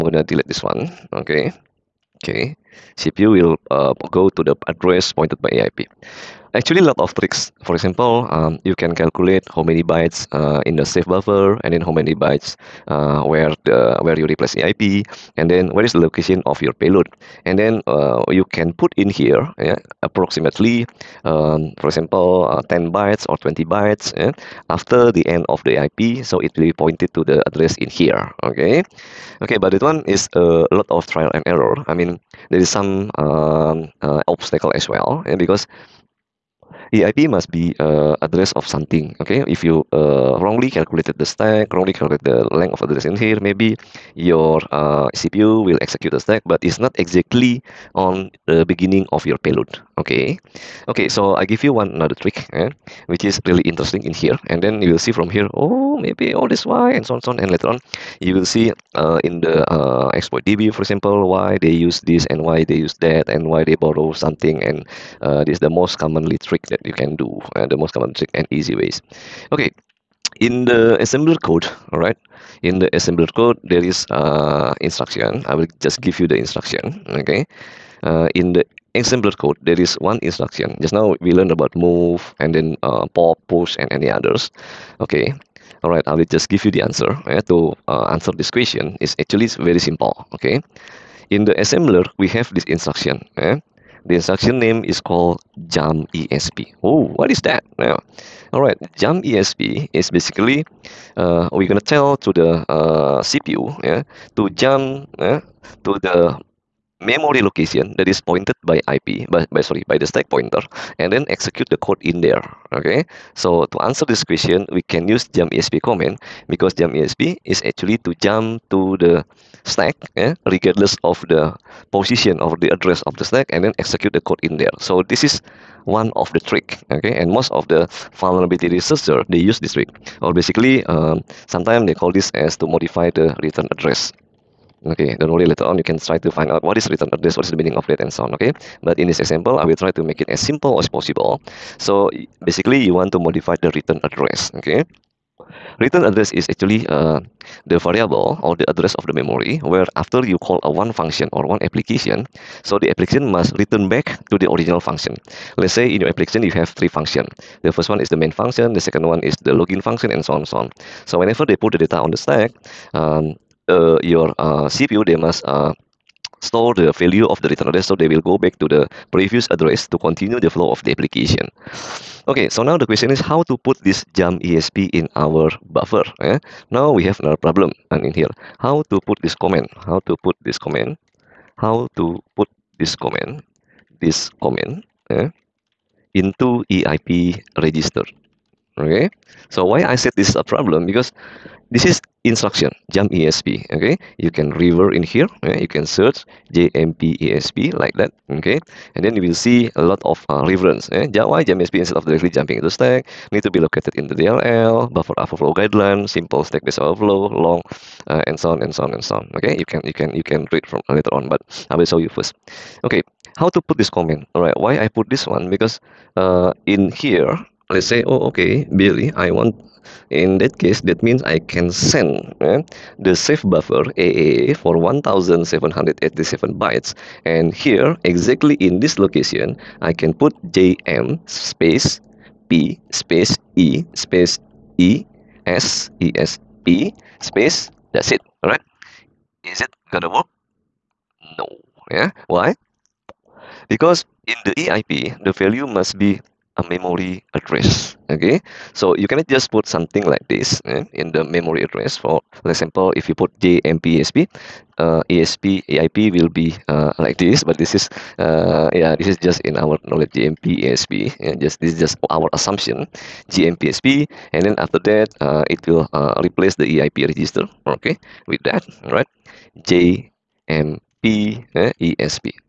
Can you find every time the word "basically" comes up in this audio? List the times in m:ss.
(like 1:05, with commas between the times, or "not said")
1:40, 2:10, 2:22.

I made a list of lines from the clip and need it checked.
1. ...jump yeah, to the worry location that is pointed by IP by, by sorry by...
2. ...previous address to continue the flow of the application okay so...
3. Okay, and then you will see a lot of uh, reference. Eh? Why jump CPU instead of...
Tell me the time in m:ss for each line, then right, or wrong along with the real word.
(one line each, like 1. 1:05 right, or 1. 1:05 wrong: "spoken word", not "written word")
1. 1:44 wrong: "memory", not "worry"
2. 2:49 right
3. 3:18 wrong: "ESP", not "CPU".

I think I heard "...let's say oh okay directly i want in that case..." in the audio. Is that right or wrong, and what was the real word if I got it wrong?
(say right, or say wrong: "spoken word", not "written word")
wrong: "billy", not "directly".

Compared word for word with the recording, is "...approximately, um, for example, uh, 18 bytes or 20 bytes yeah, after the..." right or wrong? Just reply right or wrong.
wrong.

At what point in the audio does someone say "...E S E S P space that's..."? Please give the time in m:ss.
3:54.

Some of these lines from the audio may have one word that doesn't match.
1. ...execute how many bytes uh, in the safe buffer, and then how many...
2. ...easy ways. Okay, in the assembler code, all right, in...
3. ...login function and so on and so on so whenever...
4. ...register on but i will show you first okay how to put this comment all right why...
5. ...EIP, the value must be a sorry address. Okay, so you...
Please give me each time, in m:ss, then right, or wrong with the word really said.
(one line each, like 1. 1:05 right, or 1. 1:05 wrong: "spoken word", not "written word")
1. 0:08 wrong: "calculate", not "execute"
2. 1:08 right
3. 2:39 right
4. 3:30 wrong: "later", not "register"
5. 4:04 wrong: "memory", not "sorry".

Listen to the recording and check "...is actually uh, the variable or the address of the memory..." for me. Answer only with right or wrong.
right.